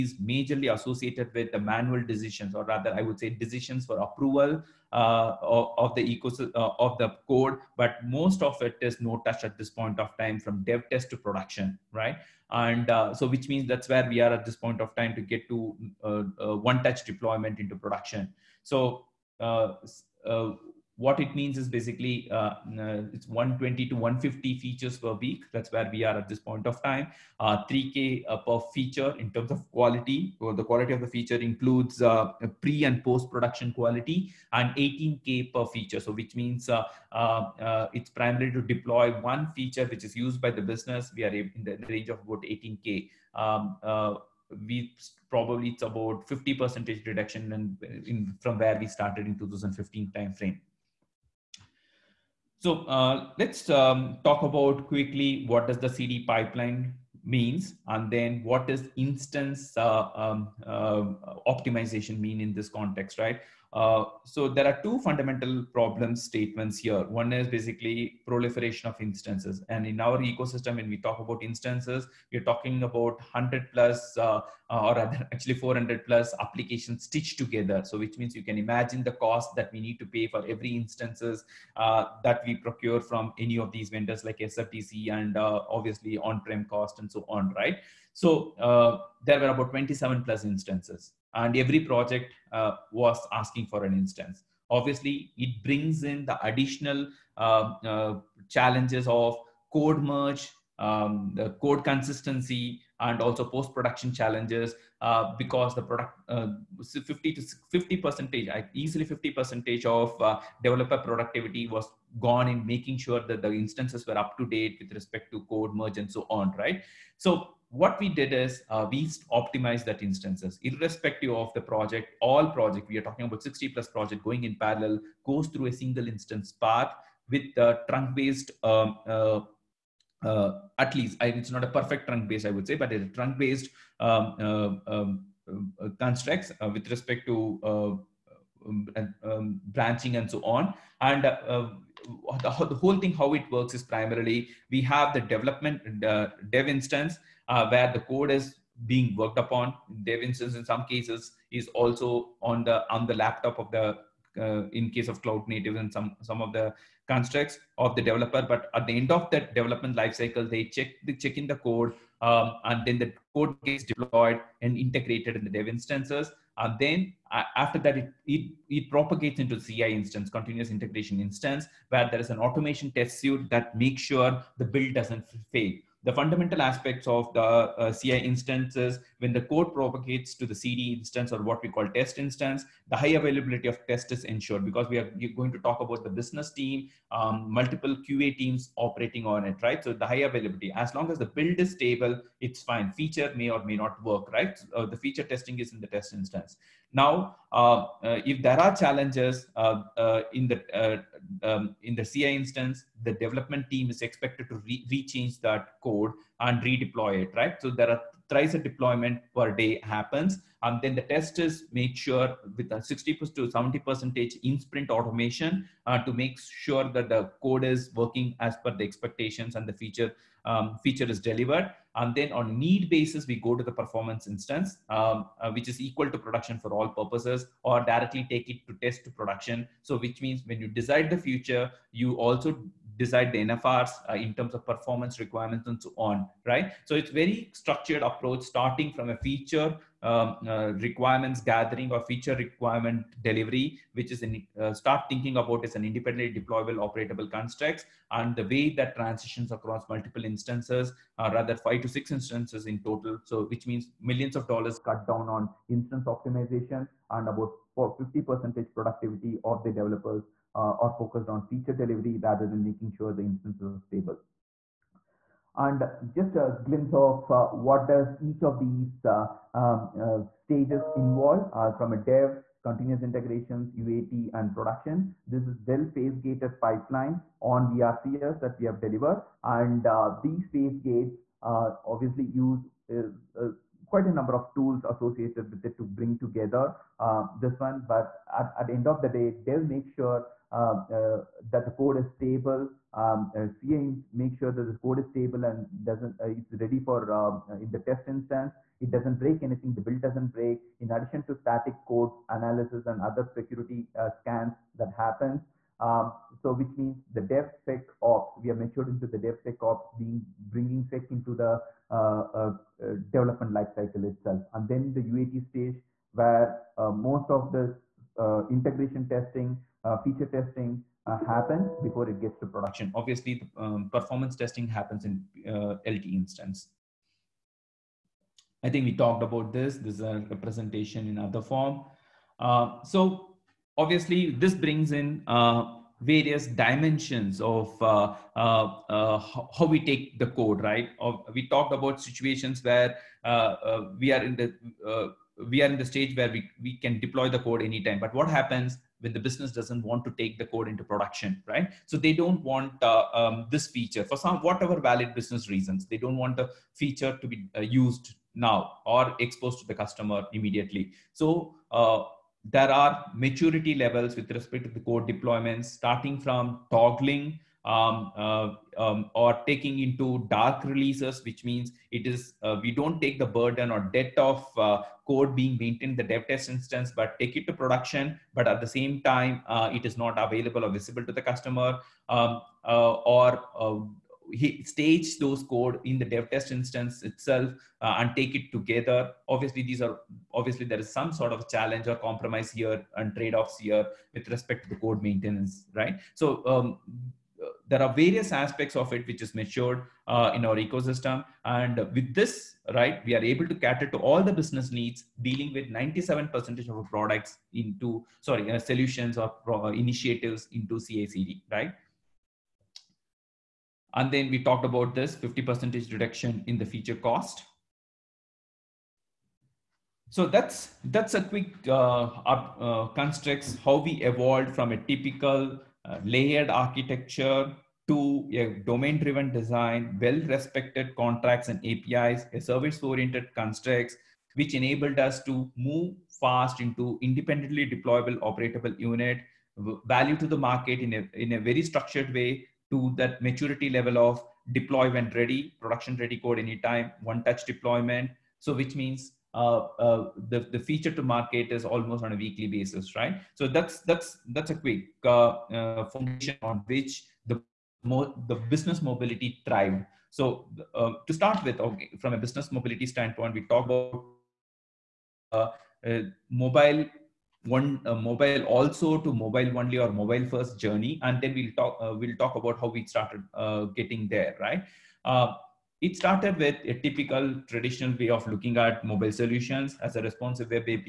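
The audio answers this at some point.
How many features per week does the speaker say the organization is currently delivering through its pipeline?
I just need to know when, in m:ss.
0:23.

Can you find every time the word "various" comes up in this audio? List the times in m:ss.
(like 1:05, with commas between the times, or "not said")
5:36, 6:37.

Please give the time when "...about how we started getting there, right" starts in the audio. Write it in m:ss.
7:52.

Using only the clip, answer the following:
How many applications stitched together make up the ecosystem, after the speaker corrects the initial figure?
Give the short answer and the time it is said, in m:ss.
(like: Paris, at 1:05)
400 plus, at 1:15.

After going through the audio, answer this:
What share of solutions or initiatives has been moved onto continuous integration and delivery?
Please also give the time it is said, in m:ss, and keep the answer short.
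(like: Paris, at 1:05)
97%, at 6:45.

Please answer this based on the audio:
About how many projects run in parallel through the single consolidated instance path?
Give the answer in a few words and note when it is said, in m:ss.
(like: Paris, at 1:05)
60 plus, at 2:03.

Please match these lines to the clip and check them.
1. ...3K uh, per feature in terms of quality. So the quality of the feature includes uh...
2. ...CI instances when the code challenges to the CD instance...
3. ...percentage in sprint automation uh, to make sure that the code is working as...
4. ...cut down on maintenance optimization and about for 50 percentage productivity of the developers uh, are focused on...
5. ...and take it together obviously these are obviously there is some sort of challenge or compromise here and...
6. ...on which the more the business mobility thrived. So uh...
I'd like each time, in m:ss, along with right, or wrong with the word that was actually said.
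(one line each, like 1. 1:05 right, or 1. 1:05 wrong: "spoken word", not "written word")
1. 0:27 right
2. 2:57 wrong: "propagates", not "challenges"
3. 3:33 right
4. 4:14 wrong: "instance", not "maintenance"
5. 6:27 right
6. 7:36 right.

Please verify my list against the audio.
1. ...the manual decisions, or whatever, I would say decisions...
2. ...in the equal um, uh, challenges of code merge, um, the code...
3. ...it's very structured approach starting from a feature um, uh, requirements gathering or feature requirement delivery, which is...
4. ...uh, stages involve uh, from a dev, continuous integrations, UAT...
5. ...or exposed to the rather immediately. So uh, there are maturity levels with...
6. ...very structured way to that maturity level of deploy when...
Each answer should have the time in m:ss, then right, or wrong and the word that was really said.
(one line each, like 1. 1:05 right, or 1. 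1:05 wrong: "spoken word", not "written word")
1. 0:01 wrong: "rather", not "whatever"
2. 1:36 wrong: "additional", not "equal"
3. 3:56 right
4. 4:30 right
5. 5:58 wrong: "customer", not "rather"
6. 7:21 right.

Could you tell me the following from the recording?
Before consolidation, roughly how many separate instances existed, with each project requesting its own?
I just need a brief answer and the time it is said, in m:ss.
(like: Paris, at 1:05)
27 plus, at 1:29.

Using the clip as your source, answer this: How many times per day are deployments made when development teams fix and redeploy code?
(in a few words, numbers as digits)
thrice.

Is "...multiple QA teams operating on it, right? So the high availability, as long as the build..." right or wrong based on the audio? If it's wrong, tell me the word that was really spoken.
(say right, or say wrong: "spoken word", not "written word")
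right.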